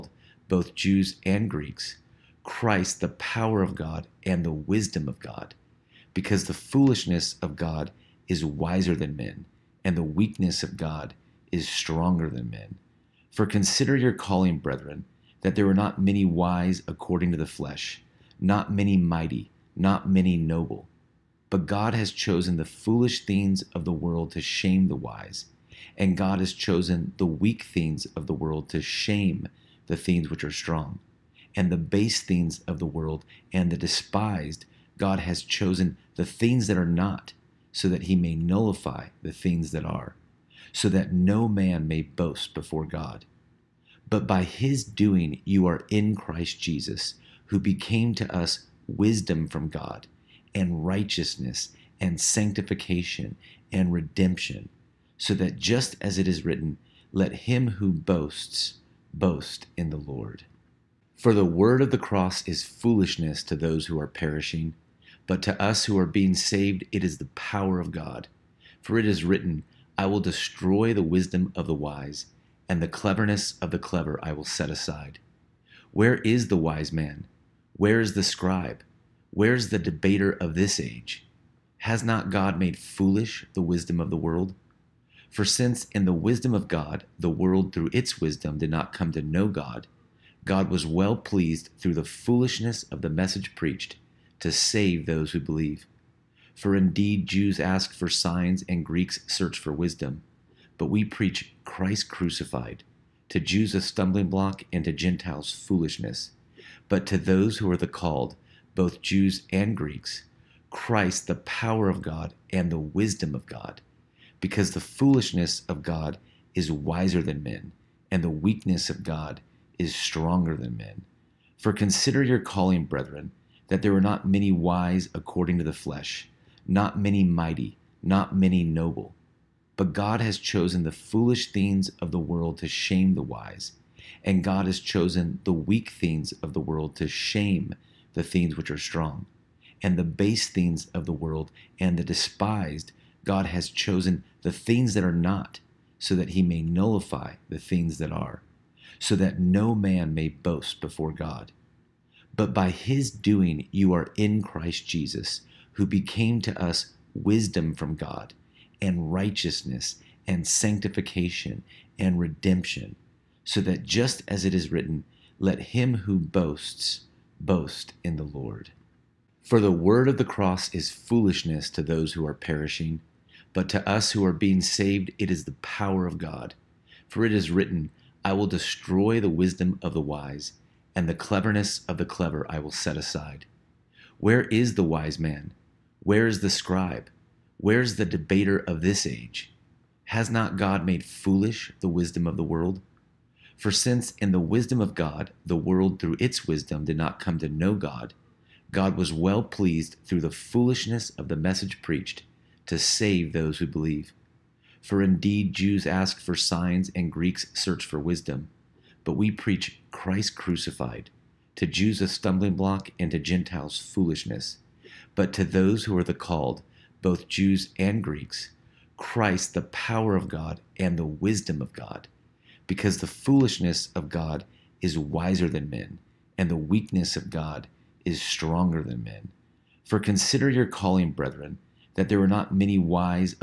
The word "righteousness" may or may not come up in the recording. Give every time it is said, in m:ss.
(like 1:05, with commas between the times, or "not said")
0:50, 2:39.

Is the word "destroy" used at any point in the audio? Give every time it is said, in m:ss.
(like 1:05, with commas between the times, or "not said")
1:10, 2:58.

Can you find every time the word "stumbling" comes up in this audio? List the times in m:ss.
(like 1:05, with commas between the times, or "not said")
1:43, 3:32.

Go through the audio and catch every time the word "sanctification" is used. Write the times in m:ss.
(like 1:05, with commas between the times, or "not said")
0:52, 2:40.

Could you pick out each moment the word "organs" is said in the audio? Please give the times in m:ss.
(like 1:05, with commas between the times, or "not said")
not said.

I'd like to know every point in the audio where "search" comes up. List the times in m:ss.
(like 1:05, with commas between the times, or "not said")
1:39, 3:27.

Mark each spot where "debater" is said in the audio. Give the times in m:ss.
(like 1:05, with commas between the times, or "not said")
1:19, 3:08.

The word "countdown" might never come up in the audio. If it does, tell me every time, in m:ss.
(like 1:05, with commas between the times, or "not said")
not said.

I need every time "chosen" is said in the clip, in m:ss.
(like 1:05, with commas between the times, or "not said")
0:22, 0:26, 0:35, 2:10, 2:14, 2:23.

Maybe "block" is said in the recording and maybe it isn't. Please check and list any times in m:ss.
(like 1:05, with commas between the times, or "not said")
1:44, 3:32.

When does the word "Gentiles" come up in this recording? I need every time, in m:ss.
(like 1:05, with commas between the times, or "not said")
1:44, 3:33.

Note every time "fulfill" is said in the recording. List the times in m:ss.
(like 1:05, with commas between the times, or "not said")
not said.